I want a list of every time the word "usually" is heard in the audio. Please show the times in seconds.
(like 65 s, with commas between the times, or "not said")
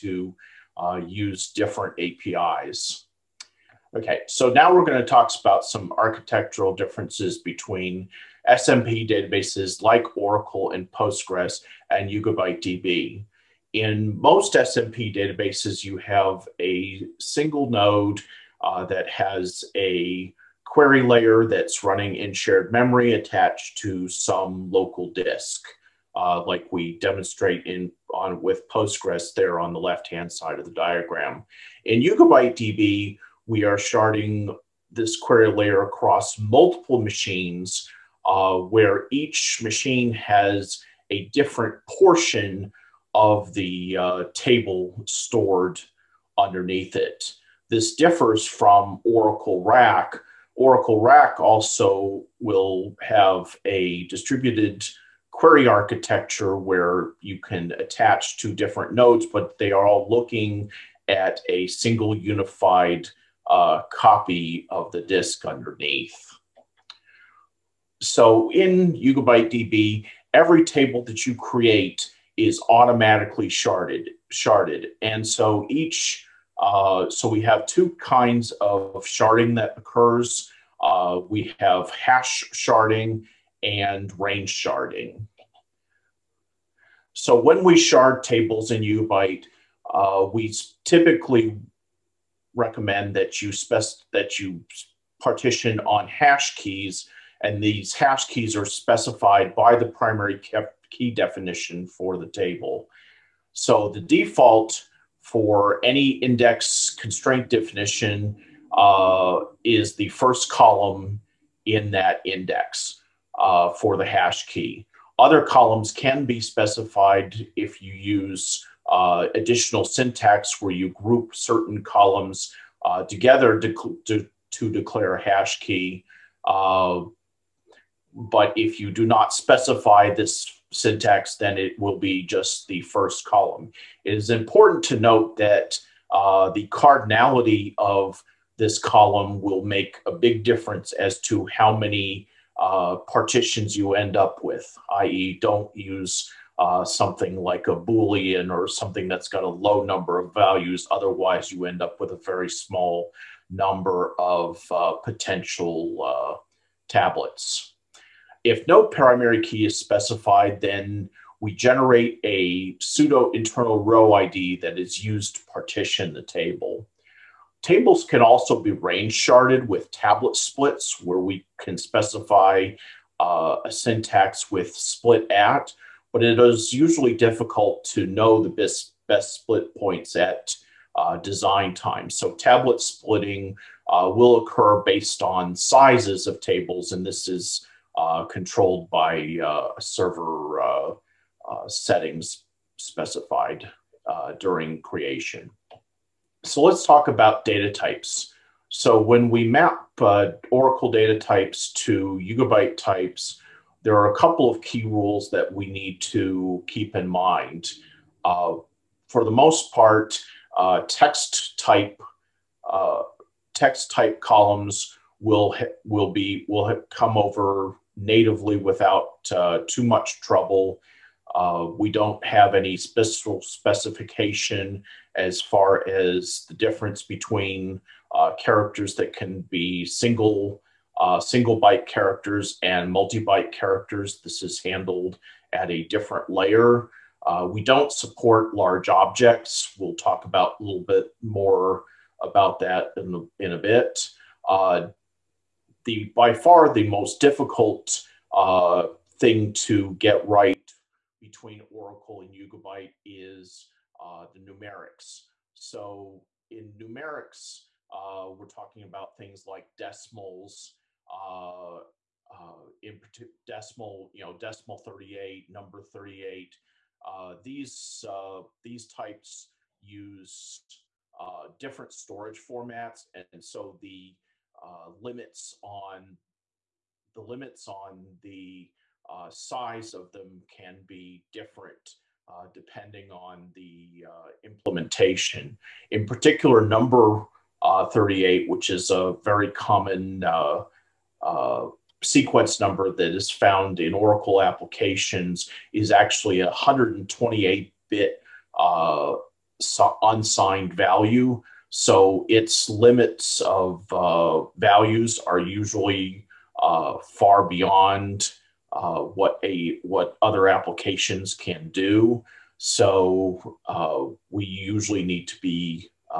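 176 s, 305 s, 314 s.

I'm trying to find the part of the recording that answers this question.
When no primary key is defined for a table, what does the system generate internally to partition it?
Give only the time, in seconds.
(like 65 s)
162 s.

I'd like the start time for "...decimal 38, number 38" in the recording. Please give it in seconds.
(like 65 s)
264 s.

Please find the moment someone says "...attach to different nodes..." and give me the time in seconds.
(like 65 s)
57 s.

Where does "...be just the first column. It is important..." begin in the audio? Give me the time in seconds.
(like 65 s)
131 s.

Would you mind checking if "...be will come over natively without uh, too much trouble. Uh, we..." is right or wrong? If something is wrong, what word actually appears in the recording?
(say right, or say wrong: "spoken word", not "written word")
right.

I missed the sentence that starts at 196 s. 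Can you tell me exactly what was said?
So let's talk about data types.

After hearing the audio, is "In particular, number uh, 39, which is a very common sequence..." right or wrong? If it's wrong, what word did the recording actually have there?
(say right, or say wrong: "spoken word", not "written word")
wrong: "38", not "39".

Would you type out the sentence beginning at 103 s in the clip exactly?
So the default for any index constraint definition uh, is the first column in that index uh, for the hash key.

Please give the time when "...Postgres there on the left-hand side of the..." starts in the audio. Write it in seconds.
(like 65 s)
28 s.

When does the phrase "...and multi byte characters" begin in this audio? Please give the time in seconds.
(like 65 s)
232 s.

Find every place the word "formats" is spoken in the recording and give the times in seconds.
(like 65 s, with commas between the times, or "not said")
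272 s.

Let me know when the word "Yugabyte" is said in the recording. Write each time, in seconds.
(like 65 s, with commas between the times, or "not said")
12 s, 32 s, 68 s, 88 s, 202 s, 252 s.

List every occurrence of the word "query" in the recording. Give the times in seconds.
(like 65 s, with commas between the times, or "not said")
20 s, 35 s, 55 s.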